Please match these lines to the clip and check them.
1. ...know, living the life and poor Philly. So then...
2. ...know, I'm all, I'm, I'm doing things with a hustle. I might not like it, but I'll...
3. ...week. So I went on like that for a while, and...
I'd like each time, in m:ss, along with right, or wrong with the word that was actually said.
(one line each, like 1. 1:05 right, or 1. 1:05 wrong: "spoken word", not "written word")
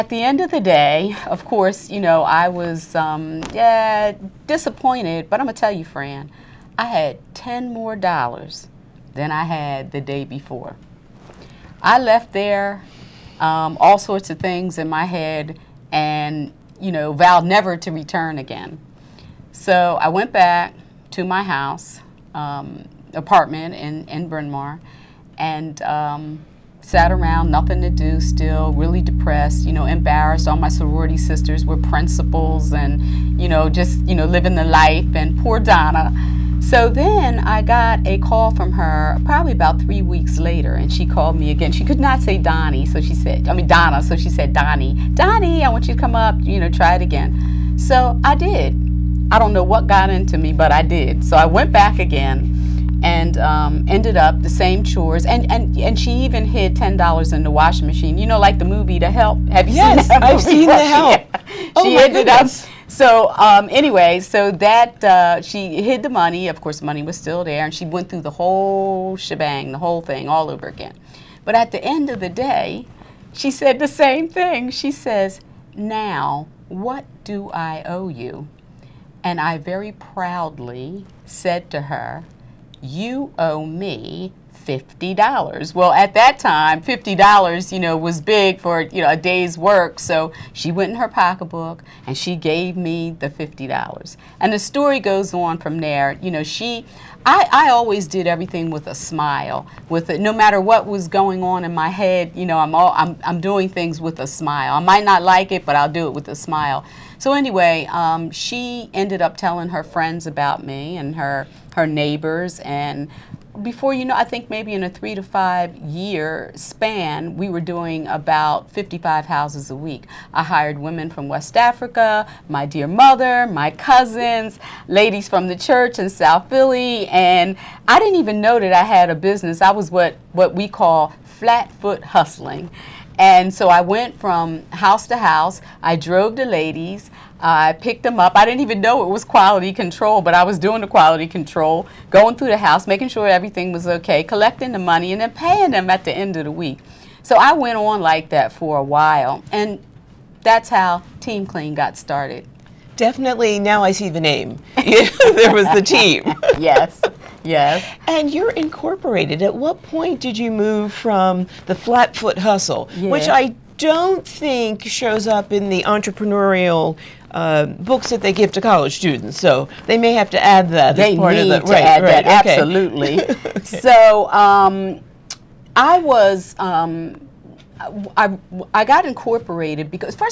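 1. 0:34 wrong: "Donna", not "Philly"
2. 1:42 wrong: "smile", not "hustle"
3. 2:26 right.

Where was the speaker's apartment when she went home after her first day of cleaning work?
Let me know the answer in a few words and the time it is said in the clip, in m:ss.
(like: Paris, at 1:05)
Bryn Mawr, at 0:24.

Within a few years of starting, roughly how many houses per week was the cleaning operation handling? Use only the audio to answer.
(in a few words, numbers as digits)
55.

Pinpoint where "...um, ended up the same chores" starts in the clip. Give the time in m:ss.
0:53.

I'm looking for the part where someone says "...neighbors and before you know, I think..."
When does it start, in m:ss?
1:51.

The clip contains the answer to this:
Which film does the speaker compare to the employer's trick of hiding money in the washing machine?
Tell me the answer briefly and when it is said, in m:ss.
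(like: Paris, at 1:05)
The Help, at 0:58.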